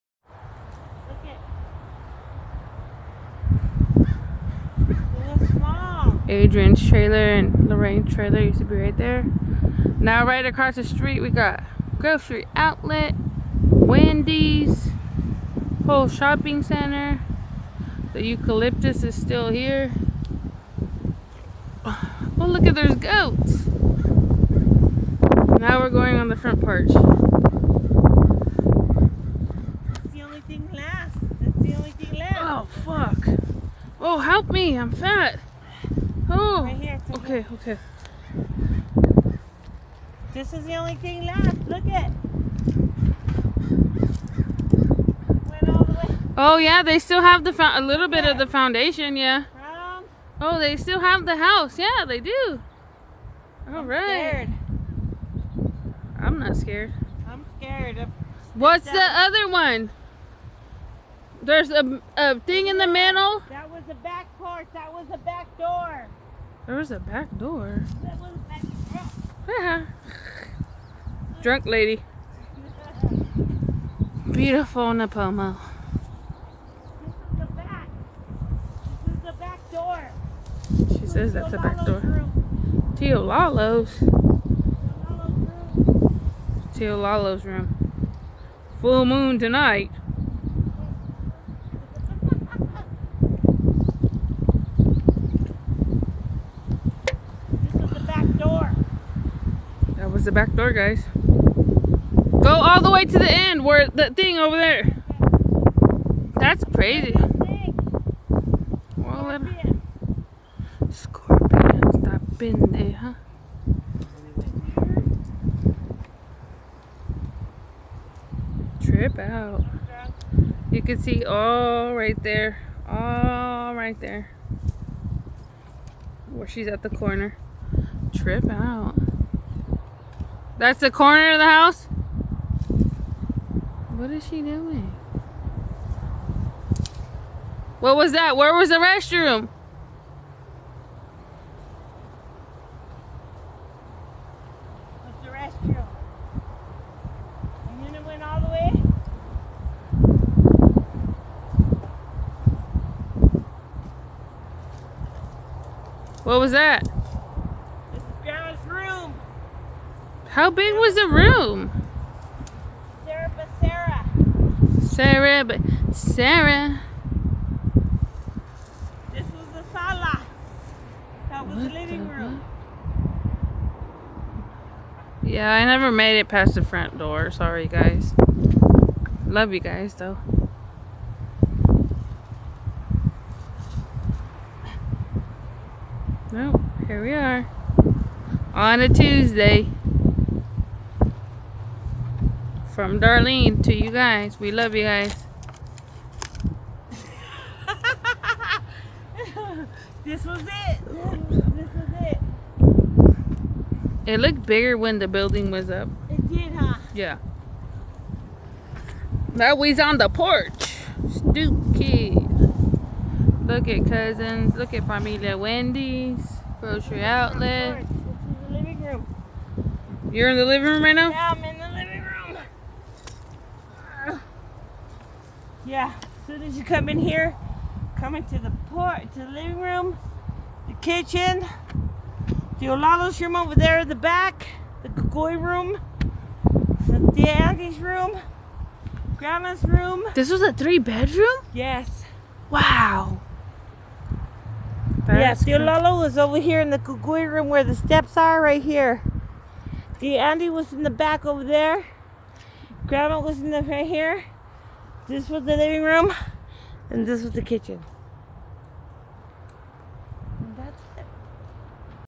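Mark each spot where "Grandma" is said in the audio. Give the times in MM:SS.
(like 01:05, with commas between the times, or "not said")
03:59, 04:12.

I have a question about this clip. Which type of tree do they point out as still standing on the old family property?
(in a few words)
eucalyptus.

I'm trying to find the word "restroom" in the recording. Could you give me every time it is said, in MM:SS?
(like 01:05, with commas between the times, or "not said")
02:18, 02:25.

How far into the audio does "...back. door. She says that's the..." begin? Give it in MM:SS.
01:19.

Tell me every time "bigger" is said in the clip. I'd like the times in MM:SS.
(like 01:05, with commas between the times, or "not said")
03:24.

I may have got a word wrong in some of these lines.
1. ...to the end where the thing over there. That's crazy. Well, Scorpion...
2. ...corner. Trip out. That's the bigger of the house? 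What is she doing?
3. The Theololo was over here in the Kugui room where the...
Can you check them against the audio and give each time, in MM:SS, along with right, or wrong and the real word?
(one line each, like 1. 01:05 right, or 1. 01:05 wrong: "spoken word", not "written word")
1. 01:43 right
2. 02:06 wrong: "corner", not "bigger"
3. 04:05 right.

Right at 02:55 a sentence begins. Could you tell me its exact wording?
Yeah, I never made it past the front door.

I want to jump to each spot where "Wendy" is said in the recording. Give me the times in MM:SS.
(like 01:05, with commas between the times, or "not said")
00:13, 03:35.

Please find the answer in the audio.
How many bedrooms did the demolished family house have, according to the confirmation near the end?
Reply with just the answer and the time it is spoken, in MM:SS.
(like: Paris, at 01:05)
3, at 04:00.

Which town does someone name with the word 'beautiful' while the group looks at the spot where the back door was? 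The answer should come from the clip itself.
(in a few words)
Nipomo.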